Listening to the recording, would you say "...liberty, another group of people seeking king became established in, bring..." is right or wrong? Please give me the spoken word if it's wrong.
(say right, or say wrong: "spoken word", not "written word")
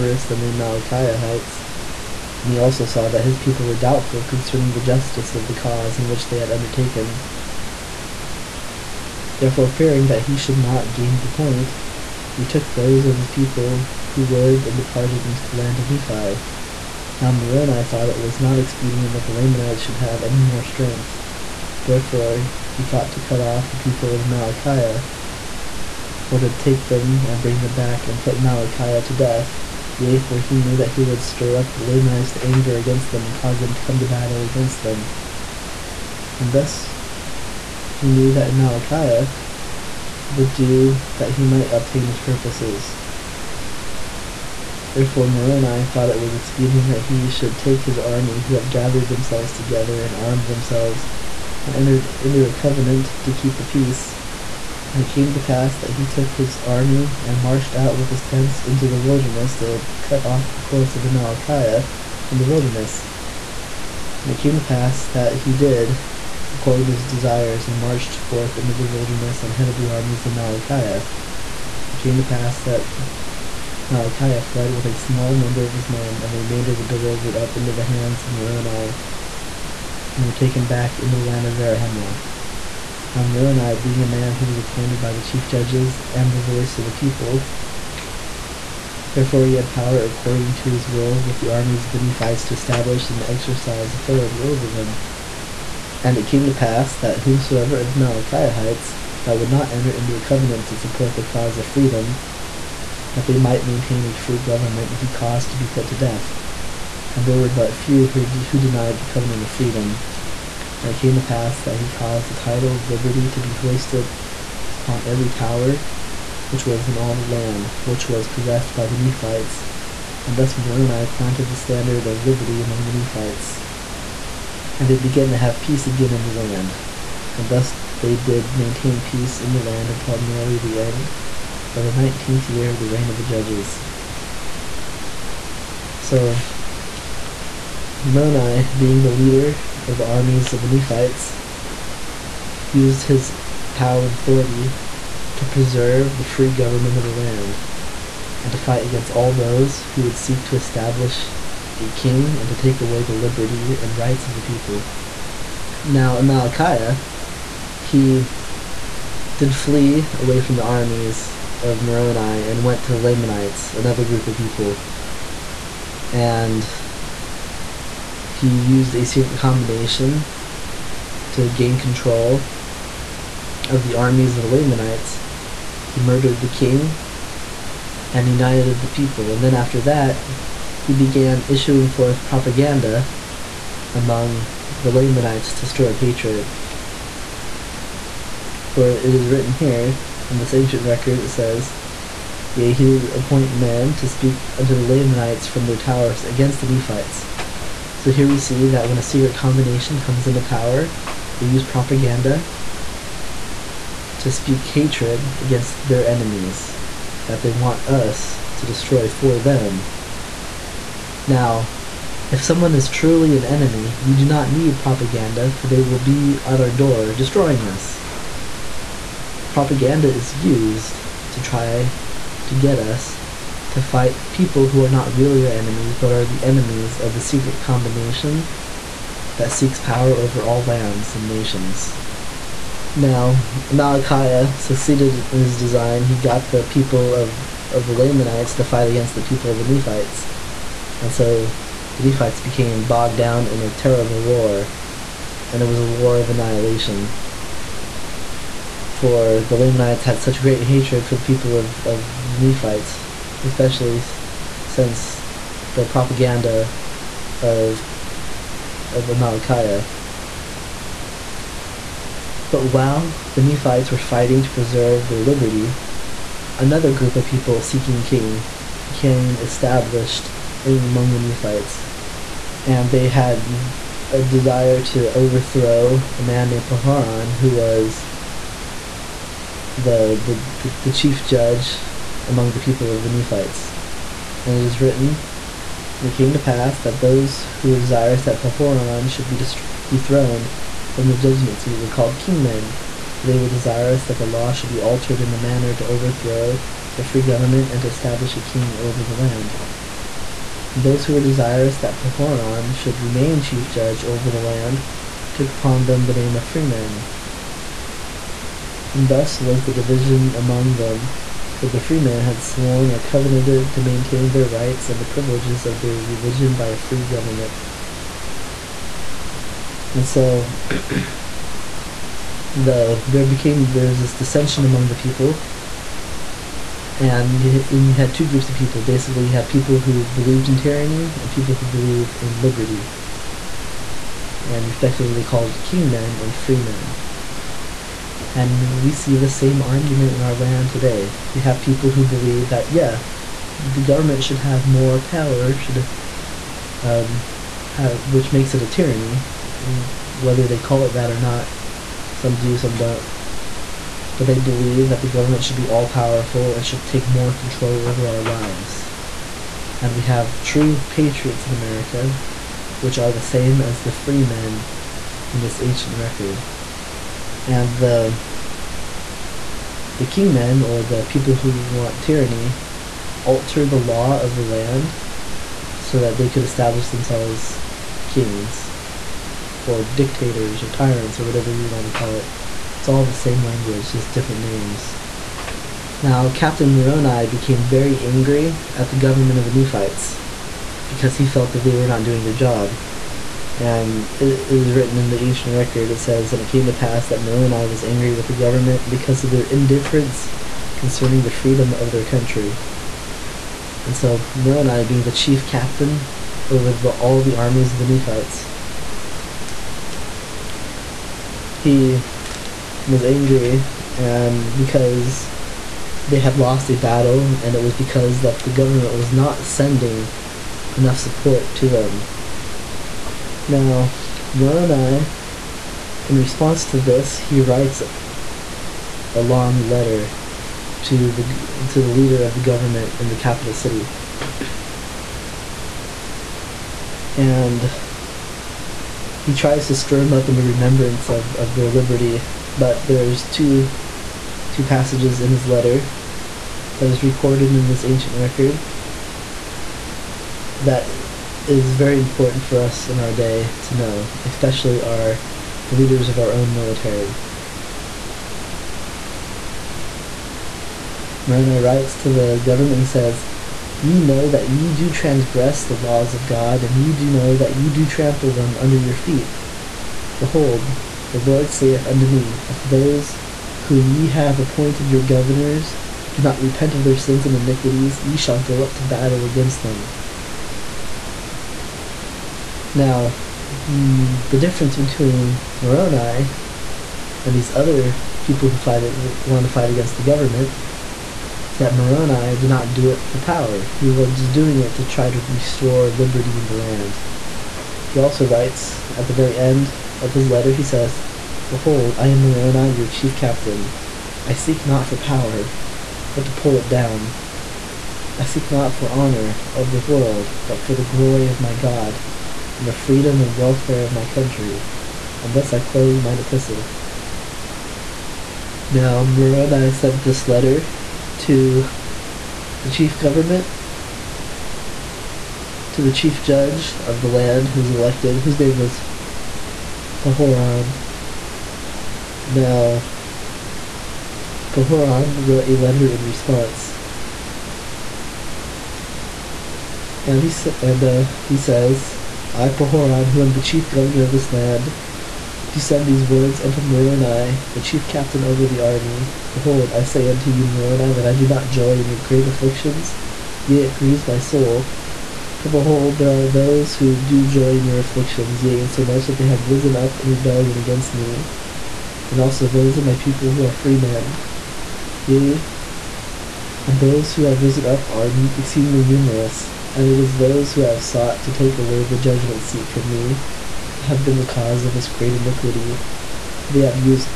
wrong: "among", not "bring".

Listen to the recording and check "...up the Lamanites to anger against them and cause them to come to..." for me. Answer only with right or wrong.
right.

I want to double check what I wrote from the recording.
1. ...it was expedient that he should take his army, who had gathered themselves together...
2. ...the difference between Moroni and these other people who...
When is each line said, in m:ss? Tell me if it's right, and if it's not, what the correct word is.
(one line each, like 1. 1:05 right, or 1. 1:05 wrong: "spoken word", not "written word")
1. 0:46 right
2. 8:04 right.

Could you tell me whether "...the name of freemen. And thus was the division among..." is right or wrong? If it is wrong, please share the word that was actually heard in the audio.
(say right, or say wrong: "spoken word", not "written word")
right.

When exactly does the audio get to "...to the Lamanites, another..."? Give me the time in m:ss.
2:42.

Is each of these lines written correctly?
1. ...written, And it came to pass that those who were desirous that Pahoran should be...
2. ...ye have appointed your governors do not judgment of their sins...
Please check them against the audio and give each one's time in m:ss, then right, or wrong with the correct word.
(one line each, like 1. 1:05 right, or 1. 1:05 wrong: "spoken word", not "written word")
1. 4:44 right
2. 7:53 wrong: "repent", not "judgment".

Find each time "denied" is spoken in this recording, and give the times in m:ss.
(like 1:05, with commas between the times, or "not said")
1:48.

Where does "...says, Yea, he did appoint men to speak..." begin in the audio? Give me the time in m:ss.
3:11.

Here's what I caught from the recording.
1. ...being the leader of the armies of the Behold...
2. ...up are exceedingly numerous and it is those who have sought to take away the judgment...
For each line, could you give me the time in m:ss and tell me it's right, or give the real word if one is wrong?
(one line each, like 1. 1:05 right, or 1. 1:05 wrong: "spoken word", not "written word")
1. 2:18 wrong: "Nephites", not "Behold"
2. 9:27 right.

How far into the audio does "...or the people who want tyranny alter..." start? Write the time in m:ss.
6:10.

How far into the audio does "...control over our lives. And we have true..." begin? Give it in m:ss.
5:57.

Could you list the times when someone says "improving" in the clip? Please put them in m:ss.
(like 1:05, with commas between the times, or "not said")
not said.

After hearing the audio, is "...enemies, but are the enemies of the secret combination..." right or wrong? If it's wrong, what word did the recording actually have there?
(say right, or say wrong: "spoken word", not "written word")
right.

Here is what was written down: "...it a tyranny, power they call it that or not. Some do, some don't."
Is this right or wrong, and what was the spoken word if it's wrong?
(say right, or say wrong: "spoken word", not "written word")
wrong: "whether", not "power".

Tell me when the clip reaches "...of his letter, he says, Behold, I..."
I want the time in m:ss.
8:19.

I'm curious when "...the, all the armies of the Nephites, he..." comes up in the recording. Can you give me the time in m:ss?
6:46.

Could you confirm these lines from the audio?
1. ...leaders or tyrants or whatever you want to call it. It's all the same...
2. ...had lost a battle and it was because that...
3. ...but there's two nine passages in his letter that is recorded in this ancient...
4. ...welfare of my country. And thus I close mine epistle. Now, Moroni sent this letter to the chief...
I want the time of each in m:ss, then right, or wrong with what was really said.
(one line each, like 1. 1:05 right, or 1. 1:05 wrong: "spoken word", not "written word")
1. 6:19 wrong: "dictators", not "leaders"
2. 6:56 right
3. 7:22 wrong: "two", not "nine"
4. 8:33 right.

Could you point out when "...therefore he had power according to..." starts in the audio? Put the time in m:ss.
1:29.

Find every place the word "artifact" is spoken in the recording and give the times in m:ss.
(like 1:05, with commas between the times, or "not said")
not said.